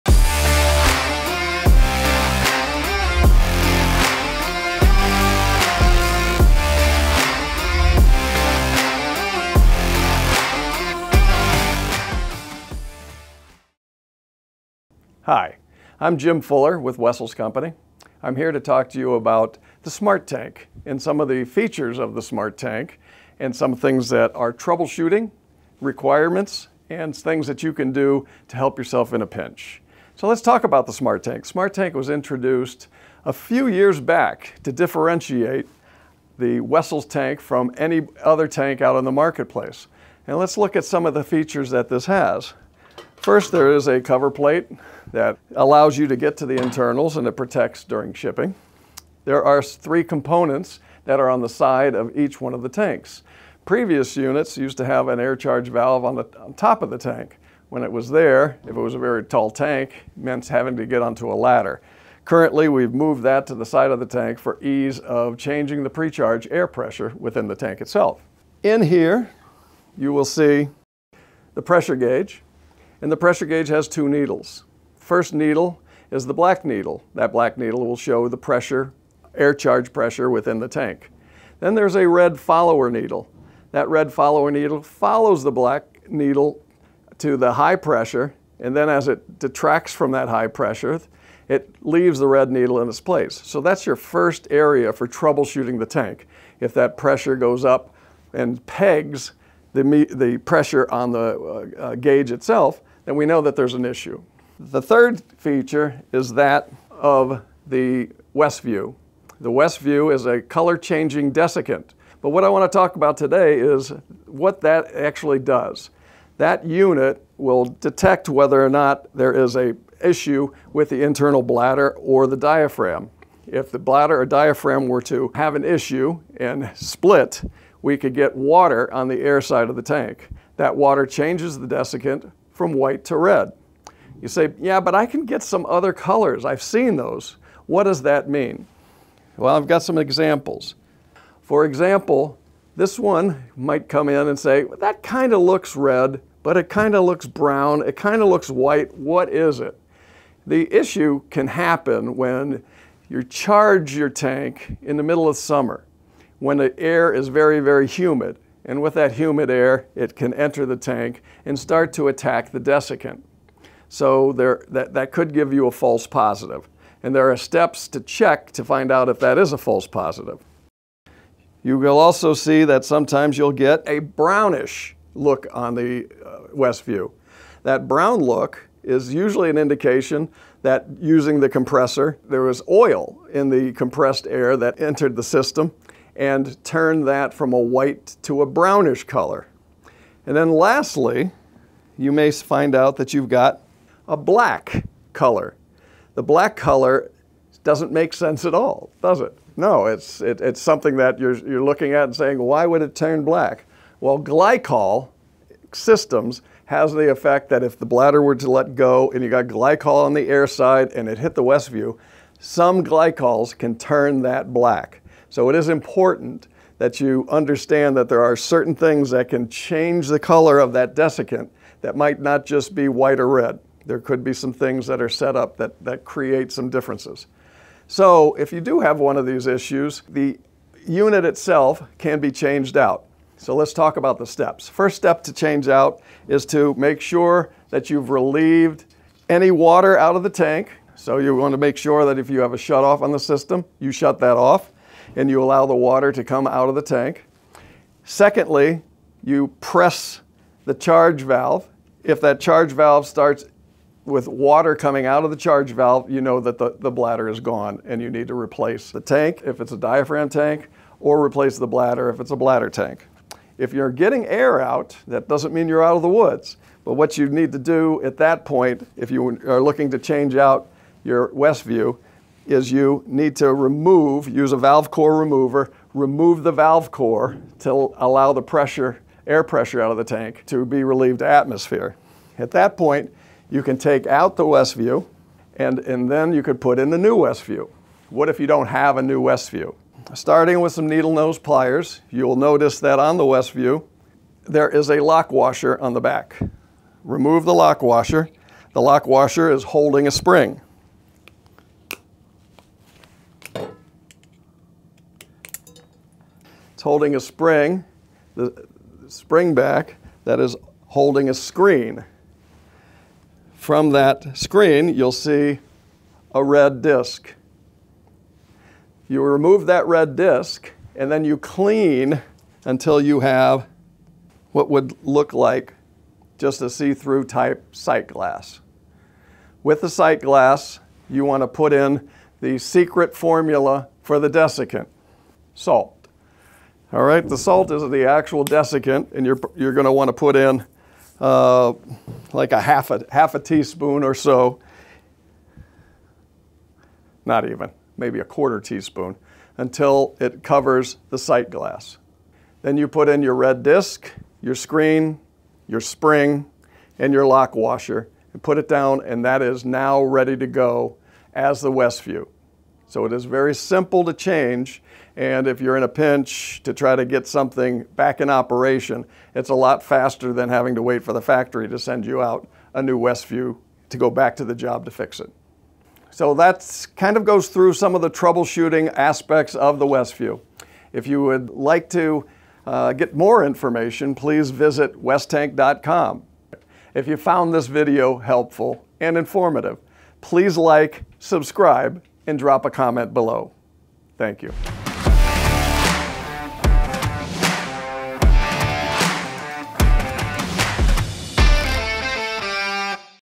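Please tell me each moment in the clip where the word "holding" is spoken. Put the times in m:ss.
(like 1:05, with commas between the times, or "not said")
4:59, 5:06, 5:10.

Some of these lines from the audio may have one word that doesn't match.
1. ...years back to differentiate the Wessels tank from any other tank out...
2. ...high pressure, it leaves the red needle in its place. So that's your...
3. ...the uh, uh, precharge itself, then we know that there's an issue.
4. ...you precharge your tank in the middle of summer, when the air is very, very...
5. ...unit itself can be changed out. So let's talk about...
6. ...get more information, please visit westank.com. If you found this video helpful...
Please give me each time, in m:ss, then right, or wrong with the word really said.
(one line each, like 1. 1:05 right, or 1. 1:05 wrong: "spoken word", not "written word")
1. 0:33 right
2. 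1:30 right
3. 1:41 wrong: "gauge", not "precharge"
4. 2:33 wrong: "charge", not "precharge"
5. 3:50 right
6. 6:22 right.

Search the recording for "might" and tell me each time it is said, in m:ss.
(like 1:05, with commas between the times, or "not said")
2:23, 3:41.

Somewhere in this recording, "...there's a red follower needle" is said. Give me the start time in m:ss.
1:21.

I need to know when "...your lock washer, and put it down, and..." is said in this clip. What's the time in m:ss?
5:57.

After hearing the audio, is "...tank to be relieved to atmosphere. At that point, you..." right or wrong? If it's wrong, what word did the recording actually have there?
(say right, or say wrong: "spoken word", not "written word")
right.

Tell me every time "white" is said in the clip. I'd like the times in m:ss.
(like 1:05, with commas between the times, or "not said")
2:12, 2:28, 3:07, 3:42.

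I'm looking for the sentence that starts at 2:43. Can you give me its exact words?
So there, that, that could give you a false positive.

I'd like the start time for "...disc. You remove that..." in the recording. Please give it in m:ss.
5:16.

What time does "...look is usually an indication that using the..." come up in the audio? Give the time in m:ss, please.
2:58.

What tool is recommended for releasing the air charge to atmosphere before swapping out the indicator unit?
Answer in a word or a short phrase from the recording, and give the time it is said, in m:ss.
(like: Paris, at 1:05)
Valve core remover, at 4:34.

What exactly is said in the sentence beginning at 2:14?
You say, yeah, but I can get some other colors.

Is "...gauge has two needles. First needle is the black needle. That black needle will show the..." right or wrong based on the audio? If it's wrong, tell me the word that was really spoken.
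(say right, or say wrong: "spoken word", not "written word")
right.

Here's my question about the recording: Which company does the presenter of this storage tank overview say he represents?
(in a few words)
Wessels Company.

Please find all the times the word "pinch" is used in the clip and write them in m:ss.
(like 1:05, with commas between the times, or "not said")
0:29, 6:05.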